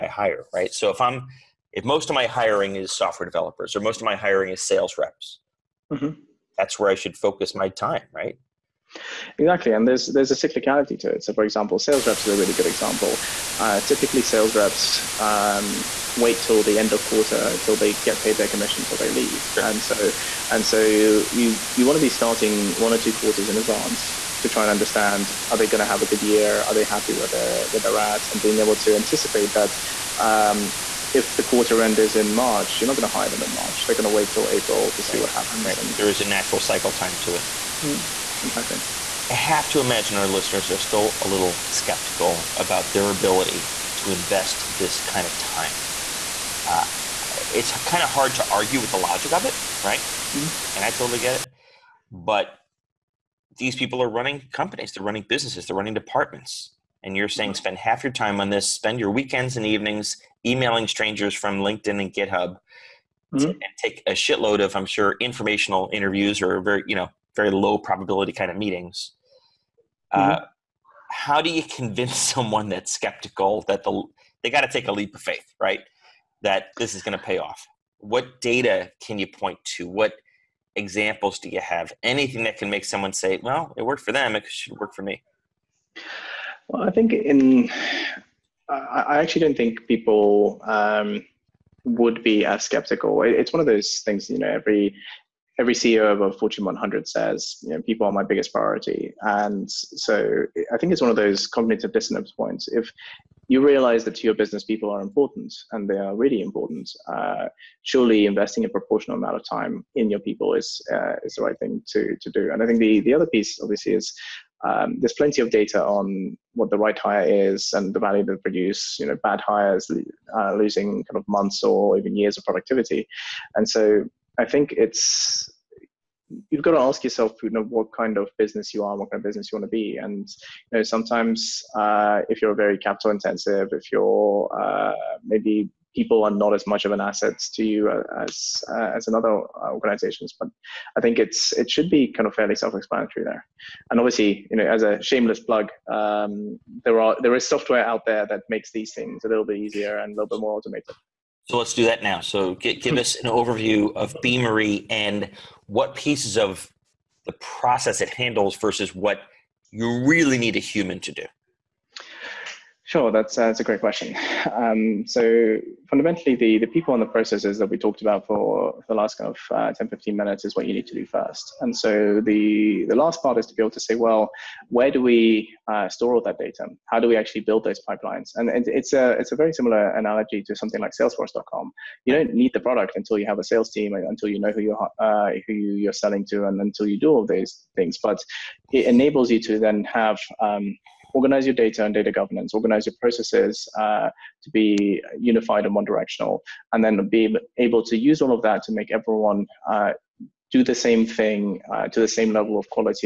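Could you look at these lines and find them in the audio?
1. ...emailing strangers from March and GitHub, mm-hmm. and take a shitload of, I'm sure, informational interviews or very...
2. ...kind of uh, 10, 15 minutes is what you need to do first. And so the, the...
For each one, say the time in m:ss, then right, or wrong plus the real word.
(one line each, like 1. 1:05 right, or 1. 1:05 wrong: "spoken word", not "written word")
1. 1:00 wrong: "LinkedIn", not "March"
2. 2:49 right.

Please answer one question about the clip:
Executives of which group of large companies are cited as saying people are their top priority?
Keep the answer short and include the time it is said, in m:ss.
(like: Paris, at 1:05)
Fortune 100, at 1:36.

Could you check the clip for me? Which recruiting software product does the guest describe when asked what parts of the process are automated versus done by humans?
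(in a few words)
Beamery.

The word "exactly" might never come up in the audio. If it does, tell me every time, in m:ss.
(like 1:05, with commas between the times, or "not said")
0:09, 0:38.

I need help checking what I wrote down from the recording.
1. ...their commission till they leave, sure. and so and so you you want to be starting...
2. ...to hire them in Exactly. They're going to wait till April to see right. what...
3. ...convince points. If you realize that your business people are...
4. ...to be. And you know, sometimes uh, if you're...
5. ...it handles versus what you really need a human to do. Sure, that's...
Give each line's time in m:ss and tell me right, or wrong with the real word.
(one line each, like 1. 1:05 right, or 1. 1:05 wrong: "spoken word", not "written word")
1. 0:18 right
2. 0:33 wrong: "March", not "Exactly"
3. 1:41 wrong: "dissonance", not "convince"
4. 2:09 right
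5. 2:38 right.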